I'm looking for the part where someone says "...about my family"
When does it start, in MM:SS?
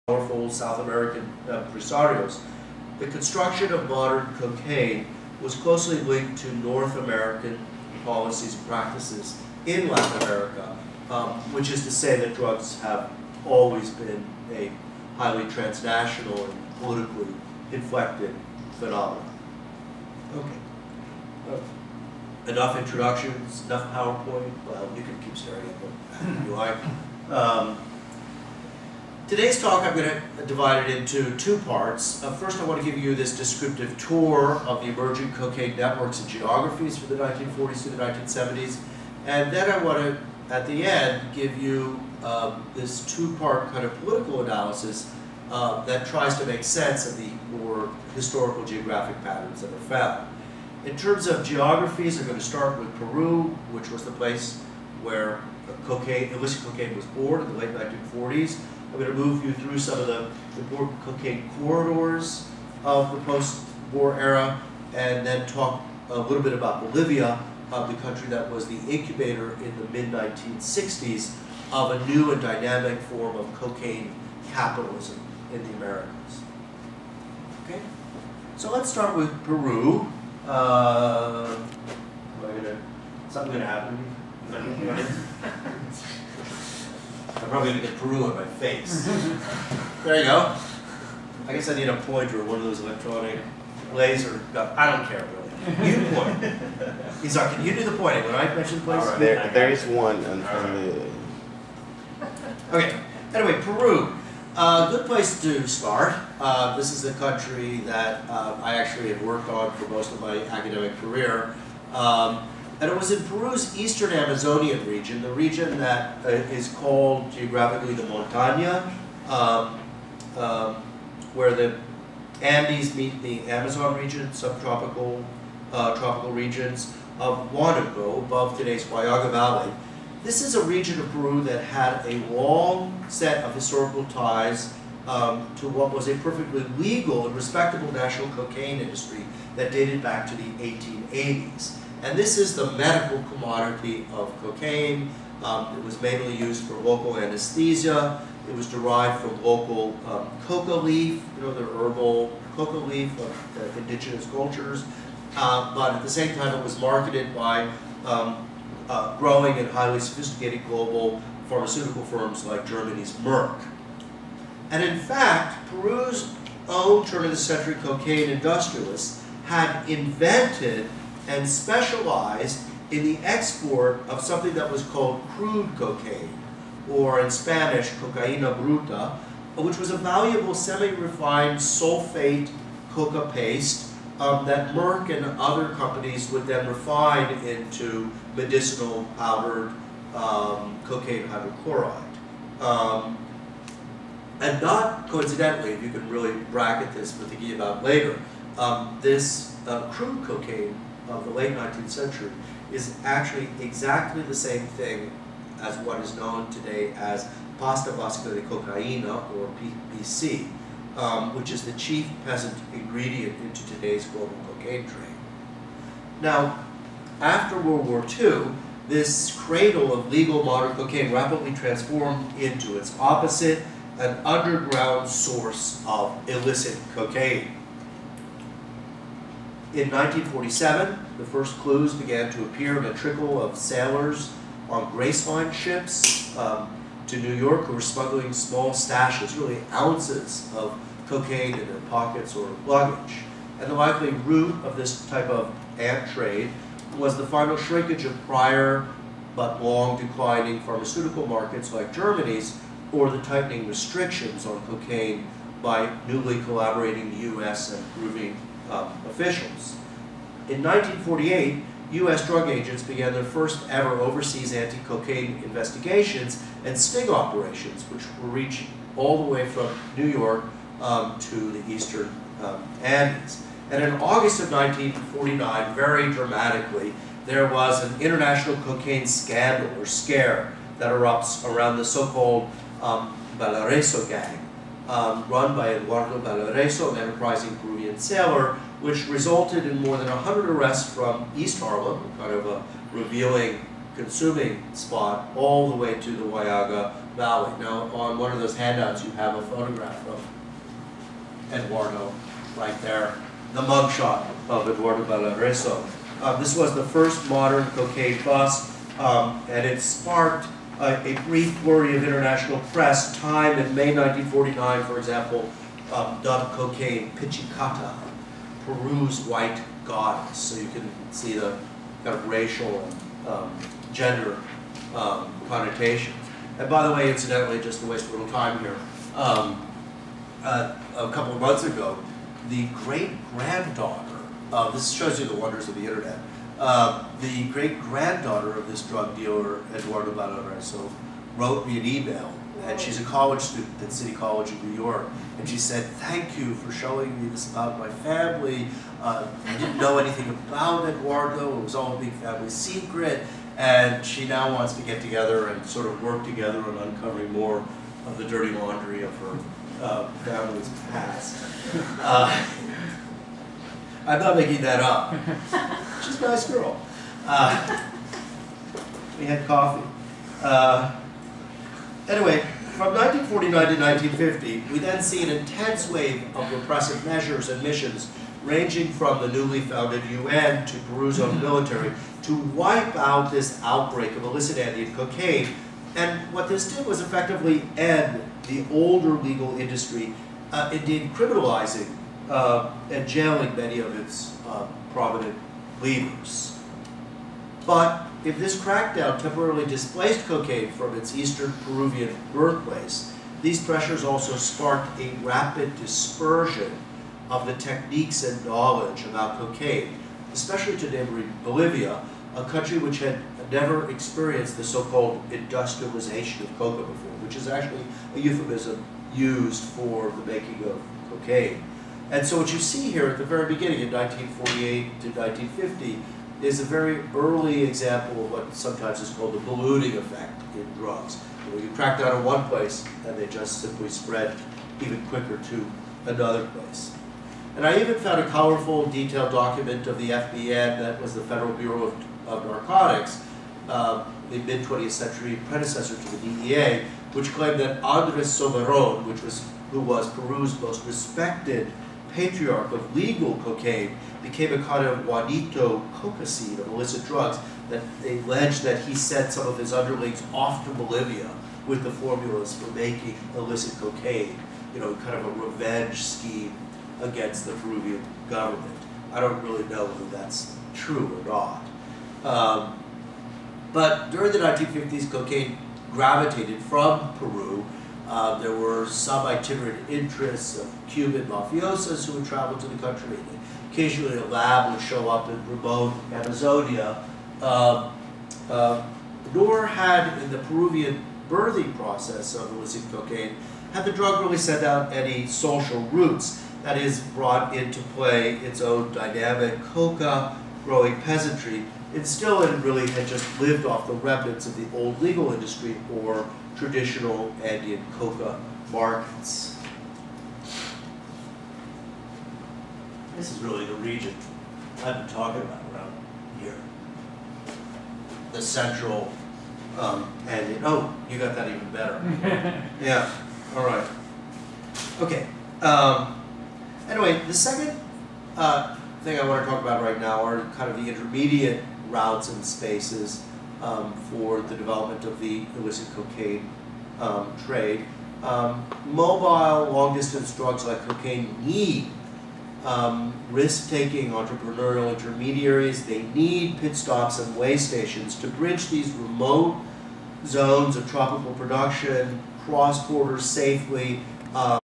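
05:47.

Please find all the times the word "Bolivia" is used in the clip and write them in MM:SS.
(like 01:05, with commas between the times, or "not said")
01:06, 06:51, 07:40.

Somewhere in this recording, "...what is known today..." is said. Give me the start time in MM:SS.
03:25.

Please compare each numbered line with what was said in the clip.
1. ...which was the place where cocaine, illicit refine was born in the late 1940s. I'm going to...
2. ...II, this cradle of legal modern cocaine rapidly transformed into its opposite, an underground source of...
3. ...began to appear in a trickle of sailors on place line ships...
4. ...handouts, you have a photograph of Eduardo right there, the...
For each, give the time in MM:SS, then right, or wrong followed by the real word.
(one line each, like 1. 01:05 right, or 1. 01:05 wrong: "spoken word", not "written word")
1. 00:53 wrong: "cocaine", not "refine"
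2. 03:38 right
3. 03:51 wrong: "grace", not "place"
4. 04:58 right.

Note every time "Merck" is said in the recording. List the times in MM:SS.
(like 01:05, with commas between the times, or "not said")
02:43, 03:04.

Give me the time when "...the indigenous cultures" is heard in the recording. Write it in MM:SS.
02:33.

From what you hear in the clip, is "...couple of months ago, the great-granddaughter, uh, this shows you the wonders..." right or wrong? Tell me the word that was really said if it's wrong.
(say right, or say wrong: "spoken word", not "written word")
right.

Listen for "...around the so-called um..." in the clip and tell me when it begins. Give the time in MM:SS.
04:41.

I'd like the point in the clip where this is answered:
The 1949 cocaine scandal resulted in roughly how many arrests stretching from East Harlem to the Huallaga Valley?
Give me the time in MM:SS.
04:49.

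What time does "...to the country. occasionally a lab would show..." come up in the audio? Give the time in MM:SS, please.
08:02.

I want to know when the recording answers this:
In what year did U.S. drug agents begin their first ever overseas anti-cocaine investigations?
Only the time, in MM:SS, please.
04:20.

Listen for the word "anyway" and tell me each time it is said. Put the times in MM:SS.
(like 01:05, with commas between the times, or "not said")
01:43, 06:12, 08:46.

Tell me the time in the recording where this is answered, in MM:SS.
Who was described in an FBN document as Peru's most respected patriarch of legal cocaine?
07:27.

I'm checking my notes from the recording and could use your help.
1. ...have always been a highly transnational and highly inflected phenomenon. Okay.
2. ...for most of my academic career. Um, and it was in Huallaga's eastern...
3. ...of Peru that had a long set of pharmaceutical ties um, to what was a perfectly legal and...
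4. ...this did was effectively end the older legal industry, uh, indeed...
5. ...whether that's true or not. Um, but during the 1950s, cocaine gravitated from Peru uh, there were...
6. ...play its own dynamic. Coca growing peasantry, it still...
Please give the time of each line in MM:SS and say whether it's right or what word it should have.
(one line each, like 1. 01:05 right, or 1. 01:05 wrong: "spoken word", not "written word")
1. 00:12 wrong: "politically", not "highly"
2. 01:49 wrong: "Peru", not "Huallaga"
3. 02:10 wrong: "historical", not "pharmaceutical"
4. 06:26 right
5. 07:49 right
6. 08:17 right.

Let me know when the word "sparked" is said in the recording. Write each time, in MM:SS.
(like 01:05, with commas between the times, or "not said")
05:09, 06:44.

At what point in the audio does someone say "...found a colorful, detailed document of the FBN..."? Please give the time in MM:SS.
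07:17.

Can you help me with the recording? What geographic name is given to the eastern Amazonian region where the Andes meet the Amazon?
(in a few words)
Montaña.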